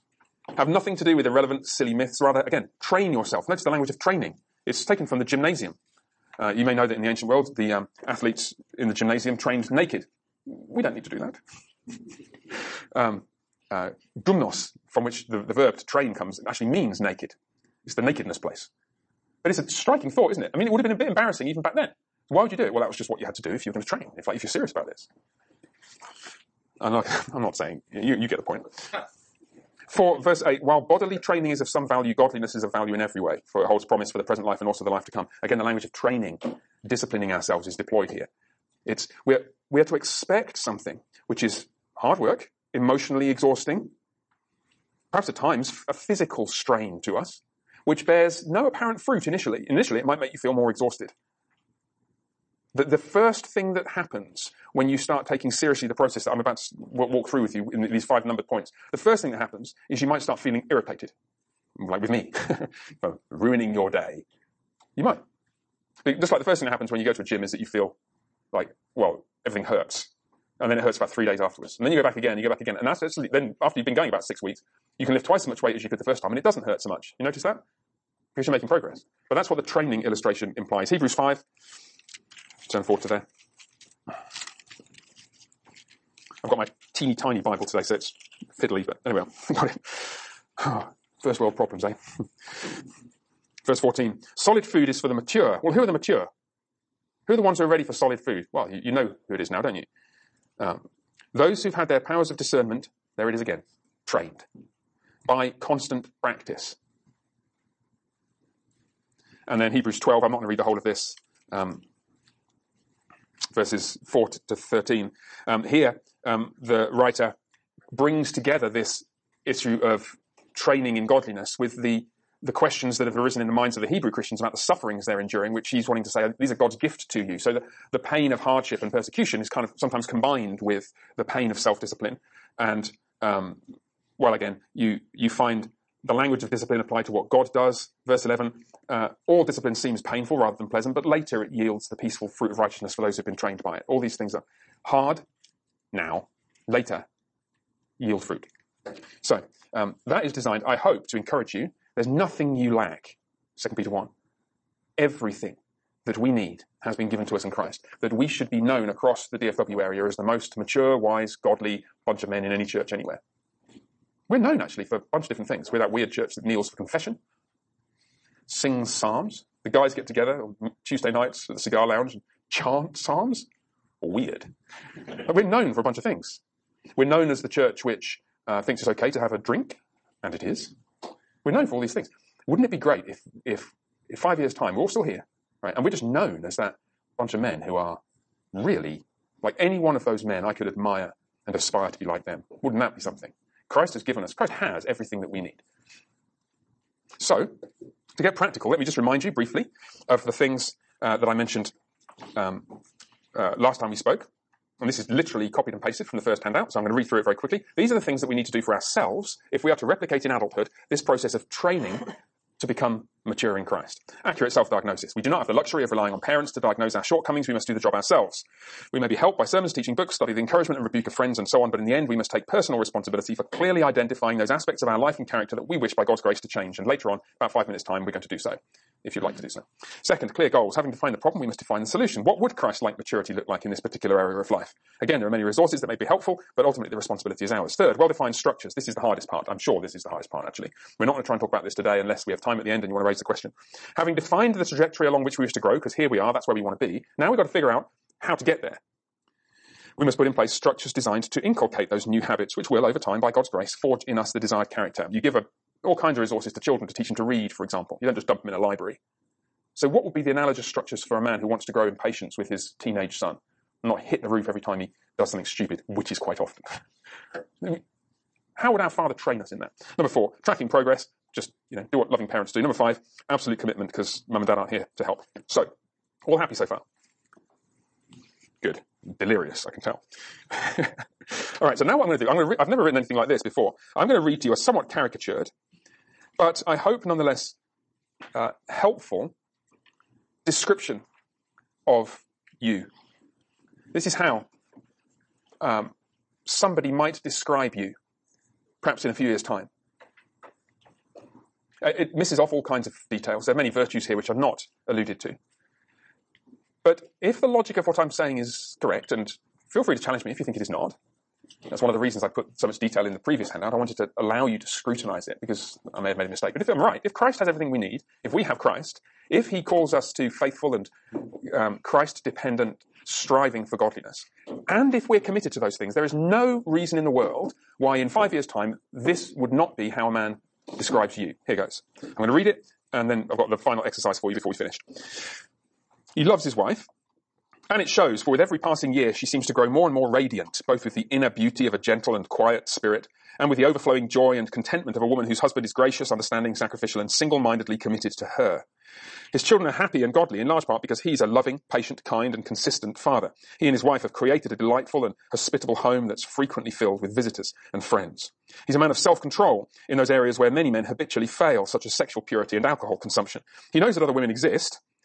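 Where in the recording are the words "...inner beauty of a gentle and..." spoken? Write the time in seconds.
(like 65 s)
341 s.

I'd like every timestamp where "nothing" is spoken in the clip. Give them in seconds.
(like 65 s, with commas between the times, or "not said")
0 s, 152 s.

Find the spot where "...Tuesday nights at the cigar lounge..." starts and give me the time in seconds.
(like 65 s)
170 s.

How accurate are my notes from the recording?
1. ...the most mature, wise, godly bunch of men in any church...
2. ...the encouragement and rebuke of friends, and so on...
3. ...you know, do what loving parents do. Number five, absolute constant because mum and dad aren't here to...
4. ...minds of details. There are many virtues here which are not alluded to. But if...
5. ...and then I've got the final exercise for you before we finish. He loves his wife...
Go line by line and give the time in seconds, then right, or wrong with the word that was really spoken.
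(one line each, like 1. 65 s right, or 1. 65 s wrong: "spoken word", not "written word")
1. 160 s right
2. 220 s right
3. 271 s wrong: "commitment", not "constant"
4. 302 s wrong: "kinds", not "minds"
5. 332 s right.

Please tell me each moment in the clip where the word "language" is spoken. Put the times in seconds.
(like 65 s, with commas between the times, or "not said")
3 s, 35 s, 136 s.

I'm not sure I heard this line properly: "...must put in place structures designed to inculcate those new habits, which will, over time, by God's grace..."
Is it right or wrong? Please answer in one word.
right.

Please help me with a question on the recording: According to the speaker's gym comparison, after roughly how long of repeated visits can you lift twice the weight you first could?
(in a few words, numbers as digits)
6 weeks.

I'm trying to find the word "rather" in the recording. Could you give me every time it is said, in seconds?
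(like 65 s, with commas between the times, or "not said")
2 s, 140 s.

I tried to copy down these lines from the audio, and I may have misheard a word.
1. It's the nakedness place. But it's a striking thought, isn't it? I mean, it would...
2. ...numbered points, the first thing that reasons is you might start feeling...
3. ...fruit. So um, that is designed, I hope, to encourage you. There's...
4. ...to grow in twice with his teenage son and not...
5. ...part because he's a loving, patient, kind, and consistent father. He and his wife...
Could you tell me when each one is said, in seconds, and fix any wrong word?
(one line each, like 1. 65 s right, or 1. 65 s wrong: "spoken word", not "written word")
1. 17 s right
2. 58 s wrong: "happens", not "reasons"
3. 148 s right
4. 261 s wrong: "patience", not "twice"
5. 350 s right.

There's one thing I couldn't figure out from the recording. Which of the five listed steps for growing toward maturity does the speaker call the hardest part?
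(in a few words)
Well-defined structures.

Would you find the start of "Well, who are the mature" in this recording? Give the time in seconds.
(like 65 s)
95 s.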